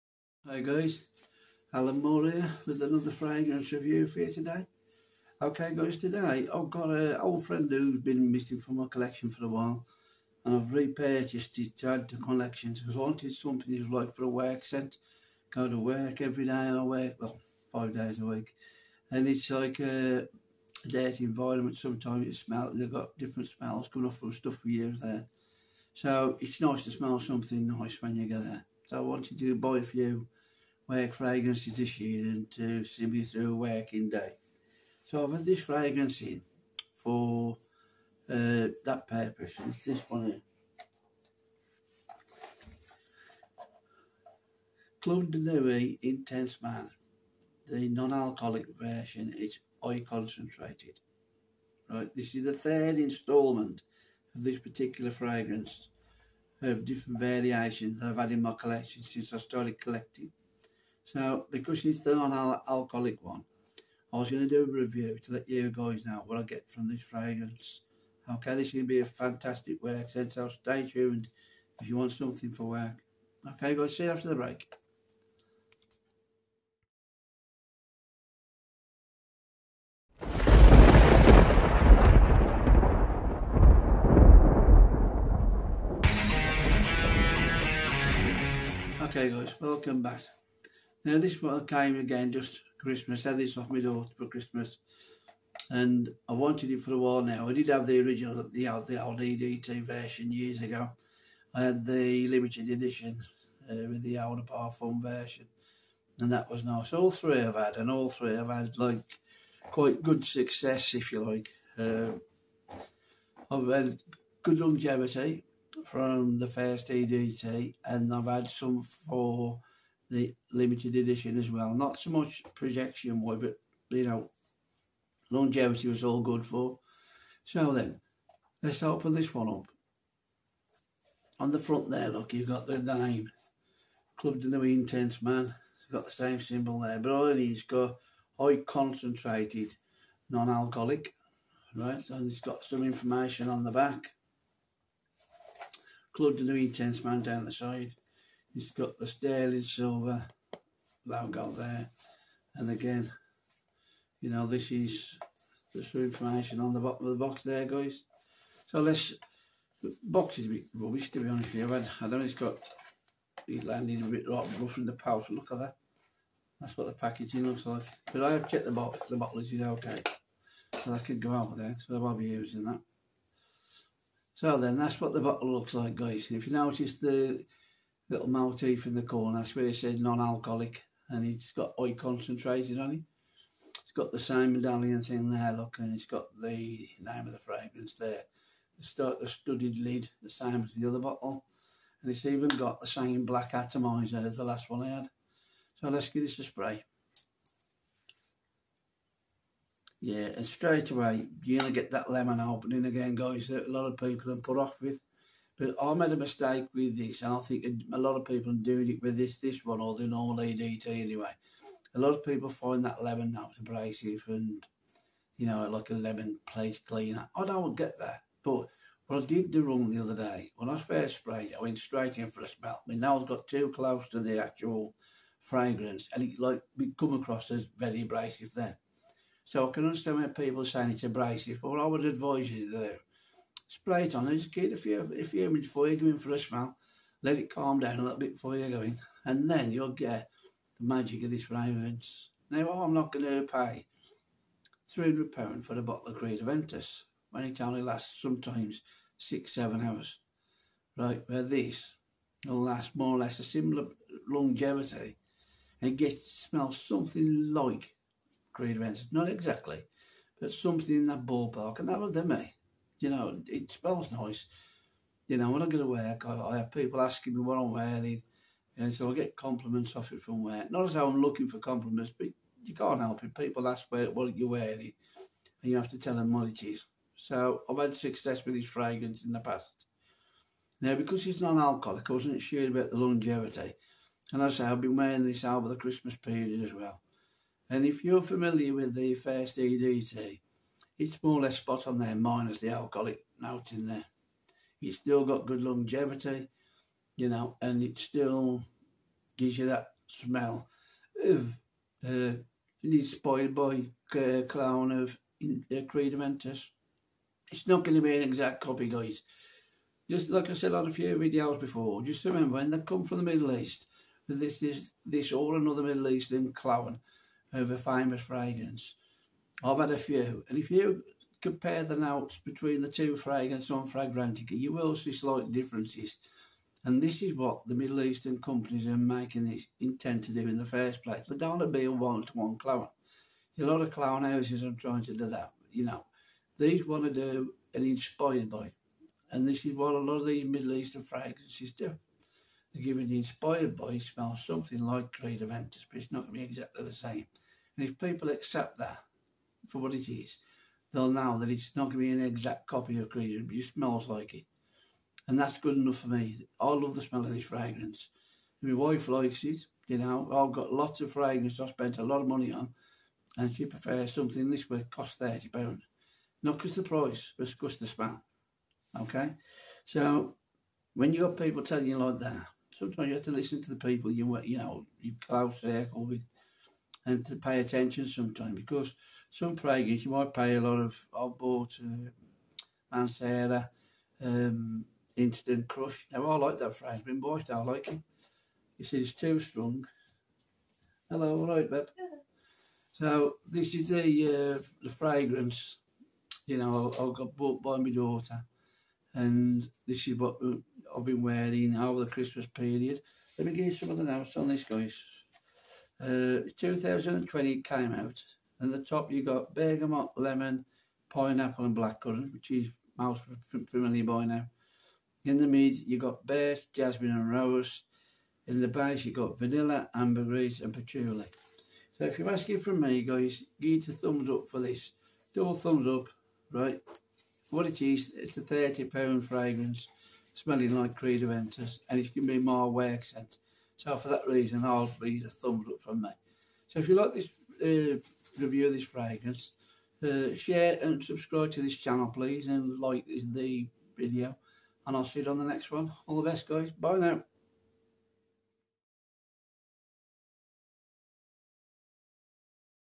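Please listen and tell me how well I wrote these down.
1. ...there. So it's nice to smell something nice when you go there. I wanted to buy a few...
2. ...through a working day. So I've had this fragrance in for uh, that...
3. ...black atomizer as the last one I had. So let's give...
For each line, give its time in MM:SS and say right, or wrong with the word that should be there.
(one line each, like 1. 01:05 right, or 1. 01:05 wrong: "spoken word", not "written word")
1. 00:25 right
2. 00:33 right
3. 03:13 right.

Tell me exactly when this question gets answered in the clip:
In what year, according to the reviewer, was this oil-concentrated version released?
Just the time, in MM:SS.
06:46.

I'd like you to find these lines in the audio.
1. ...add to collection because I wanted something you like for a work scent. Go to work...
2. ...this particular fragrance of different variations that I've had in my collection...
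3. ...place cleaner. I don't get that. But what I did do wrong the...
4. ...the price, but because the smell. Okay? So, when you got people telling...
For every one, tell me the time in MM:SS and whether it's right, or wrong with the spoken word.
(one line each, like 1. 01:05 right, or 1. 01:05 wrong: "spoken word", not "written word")
1. 00:11 right
2. 00:54 right
3. 03:36 right
4. 06:06 right.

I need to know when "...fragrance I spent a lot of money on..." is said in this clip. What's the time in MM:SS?
06:01.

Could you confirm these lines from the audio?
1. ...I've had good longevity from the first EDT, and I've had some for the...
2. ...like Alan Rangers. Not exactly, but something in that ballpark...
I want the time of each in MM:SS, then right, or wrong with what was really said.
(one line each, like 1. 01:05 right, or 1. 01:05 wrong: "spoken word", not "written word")
1. 01:53 right
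2. 04:17 wrong: "Creed", not "Alan".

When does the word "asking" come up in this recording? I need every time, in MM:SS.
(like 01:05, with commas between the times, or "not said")
04:27, 07:02.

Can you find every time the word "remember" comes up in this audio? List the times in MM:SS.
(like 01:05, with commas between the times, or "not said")
05:12.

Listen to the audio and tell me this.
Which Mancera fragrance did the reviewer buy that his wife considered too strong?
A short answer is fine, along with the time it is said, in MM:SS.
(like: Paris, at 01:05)
Instant Crush, at 06:25.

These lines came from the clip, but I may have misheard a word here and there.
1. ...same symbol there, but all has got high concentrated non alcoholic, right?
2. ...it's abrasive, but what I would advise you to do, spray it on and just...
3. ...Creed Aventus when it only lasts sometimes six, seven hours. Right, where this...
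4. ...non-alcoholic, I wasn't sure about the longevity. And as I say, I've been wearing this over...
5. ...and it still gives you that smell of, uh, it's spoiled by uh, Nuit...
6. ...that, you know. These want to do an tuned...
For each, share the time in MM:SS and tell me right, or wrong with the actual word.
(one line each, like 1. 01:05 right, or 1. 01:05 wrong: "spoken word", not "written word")
1. 02:16 right
2. 03:50 right
3. 04:06 right
4. 04:41 right
5. 04:57 wrong: "Clown", not "Nuit"
6. 05:35 wrong: "inspired", not "tuned".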